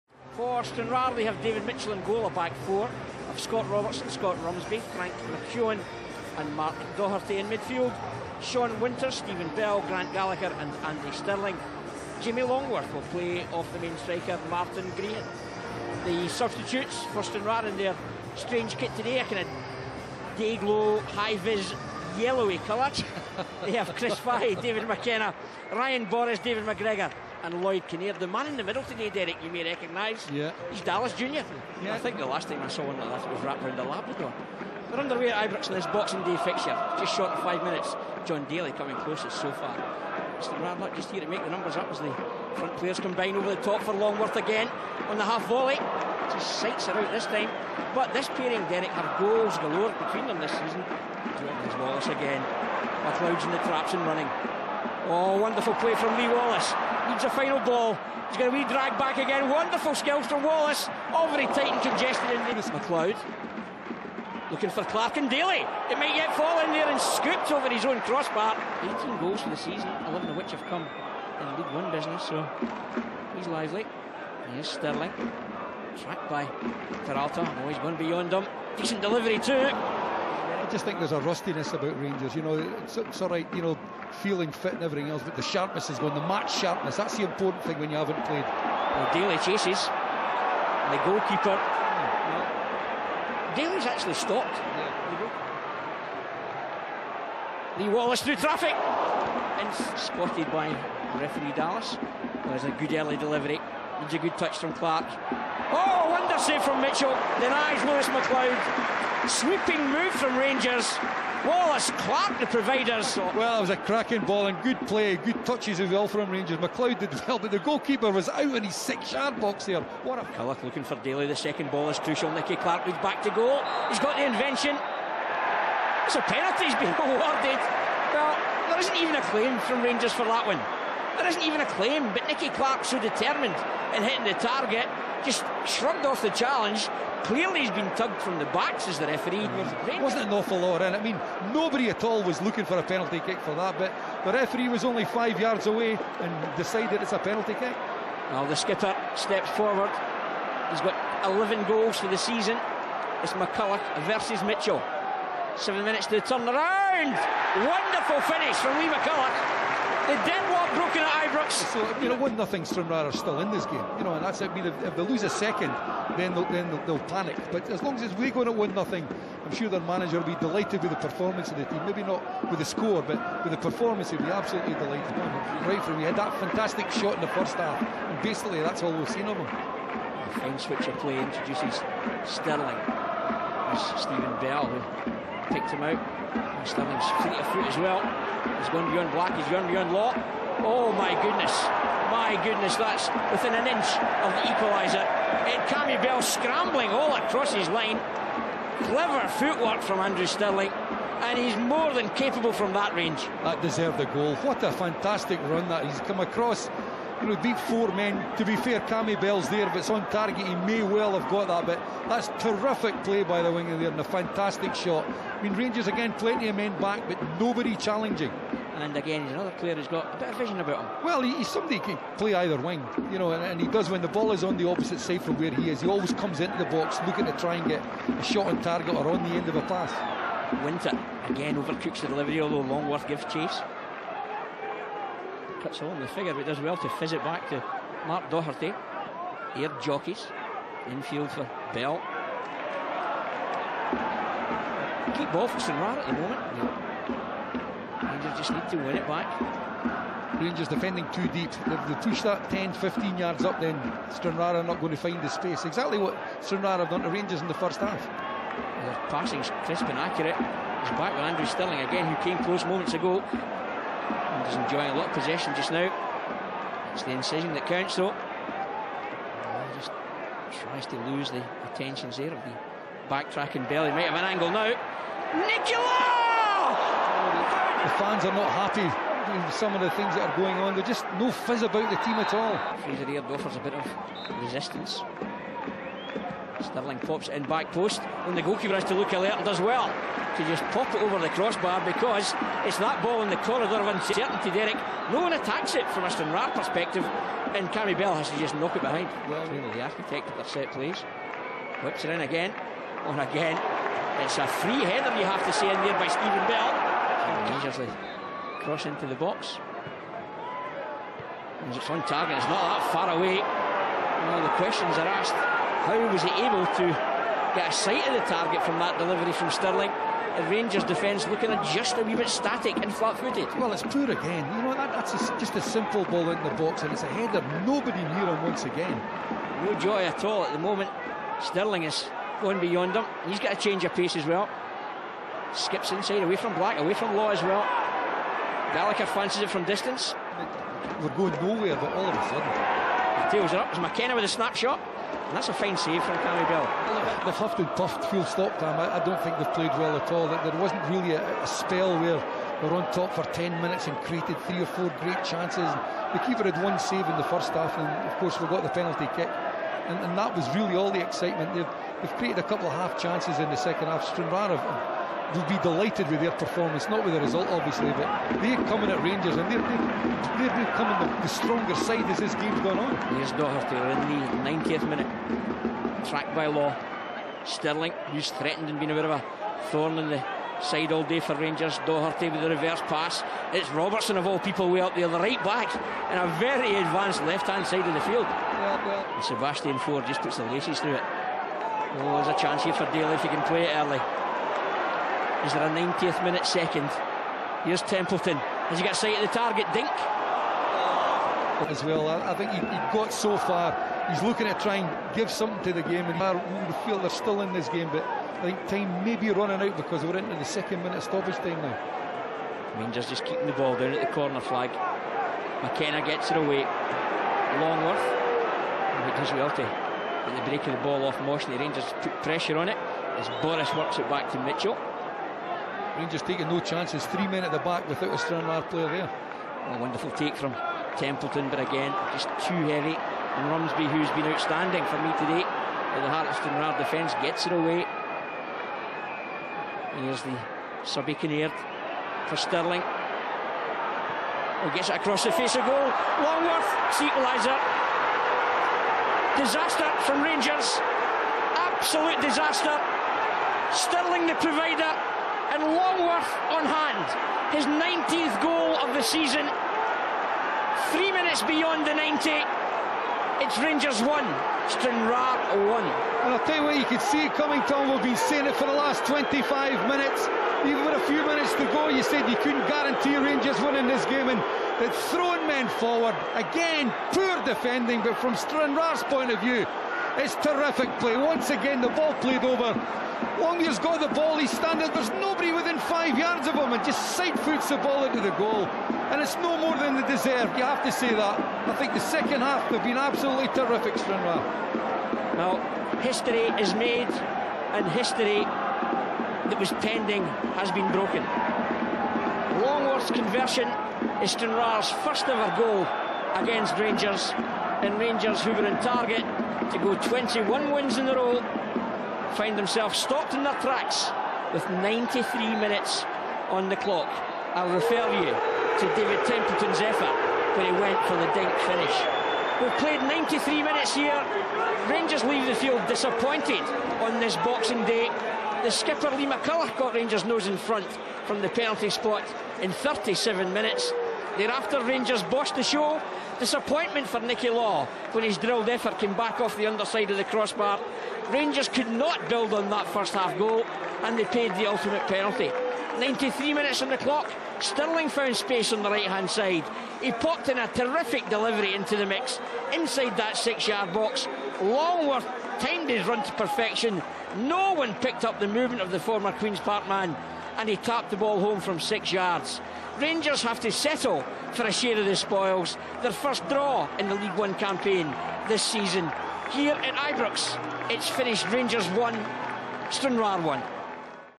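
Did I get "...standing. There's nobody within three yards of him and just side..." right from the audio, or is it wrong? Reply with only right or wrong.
wrong.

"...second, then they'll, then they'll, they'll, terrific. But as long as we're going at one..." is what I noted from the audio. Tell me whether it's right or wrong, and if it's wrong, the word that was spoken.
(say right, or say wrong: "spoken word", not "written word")
wrong: "panic", not "terrific".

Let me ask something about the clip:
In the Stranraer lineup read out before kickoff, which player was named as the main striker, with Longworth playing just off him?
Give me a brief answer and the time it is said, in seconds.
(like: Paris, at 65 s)
Martin Grehan, at 14 s.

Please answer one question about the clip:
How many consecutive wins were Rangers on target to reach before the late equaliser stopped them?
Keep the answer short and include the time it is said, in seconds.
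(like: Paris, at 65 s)
21, at 509 s.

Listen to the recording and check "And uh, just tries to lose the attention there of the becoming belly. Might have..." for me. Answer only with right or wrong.
wrong.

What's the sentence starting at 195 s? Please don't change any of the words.
Ed Cammy Bell scrambling all across his line.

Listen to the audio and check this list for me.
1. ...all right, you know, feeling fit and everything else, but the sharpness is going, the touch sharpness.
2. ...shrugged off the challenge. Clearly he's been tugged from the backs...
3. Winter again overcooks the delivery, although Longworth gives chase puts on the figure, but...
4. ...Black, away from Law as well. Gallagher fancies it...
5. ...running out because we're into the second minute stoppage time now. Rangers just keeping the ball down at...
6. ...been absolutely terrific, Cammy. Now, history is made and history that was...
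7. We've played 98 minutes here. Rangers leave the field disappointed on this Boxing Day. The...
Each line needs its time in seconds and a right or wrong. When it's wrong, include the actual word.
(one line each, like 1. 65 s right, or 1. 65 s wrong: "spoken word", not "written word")
1. 83 s wrong: "match", not "touch"
2. 135 s right
3. 230 s right
4. 336 s right
5. 409 s right
6. 492 s wrong: "Stranraer", not "Cammy"
7. 522 s wrong: "93", not "98".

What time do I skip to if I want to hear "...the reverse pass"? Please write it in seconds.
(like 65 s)
382 s.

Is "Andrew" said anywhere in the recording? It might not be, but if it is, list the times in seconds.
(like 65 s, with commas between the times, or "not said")
199 s, 261 s.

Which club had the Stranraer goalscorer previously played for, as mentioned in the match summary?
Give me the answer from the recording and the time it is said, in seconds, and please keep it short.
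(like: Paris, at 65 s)
Queen's Park, at 559 s.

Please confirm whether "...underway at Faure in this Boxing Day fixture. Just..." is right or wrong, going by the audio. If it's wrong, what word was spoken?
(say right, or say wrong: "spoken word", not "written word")
wrong: "Ibrox", not "Faure".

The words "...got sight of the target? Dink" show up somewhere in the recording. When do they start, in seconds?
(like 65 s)
398 s.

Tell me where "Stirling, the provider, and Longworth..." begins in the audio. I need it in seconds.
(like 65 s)
453 s.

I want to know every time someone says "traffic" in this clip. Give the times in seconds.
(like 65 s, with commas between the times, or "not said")
98 s.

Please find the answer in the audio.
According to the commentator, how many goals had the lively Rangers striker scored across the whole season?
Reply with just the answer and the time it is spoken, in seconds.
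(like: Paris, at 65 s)
18, at 68 s.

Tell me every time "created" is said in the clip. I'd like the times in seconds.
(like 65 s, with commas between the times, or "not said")
353 s, 362 s.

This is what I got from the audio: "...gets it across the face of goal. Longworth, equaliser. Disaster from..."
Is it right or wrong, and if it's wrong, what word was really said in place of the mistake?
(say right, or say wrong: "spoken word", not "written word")
right.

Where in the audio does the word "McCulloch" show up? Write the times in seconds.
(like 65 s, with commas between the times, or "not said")
153 s, 158 s, 529 s.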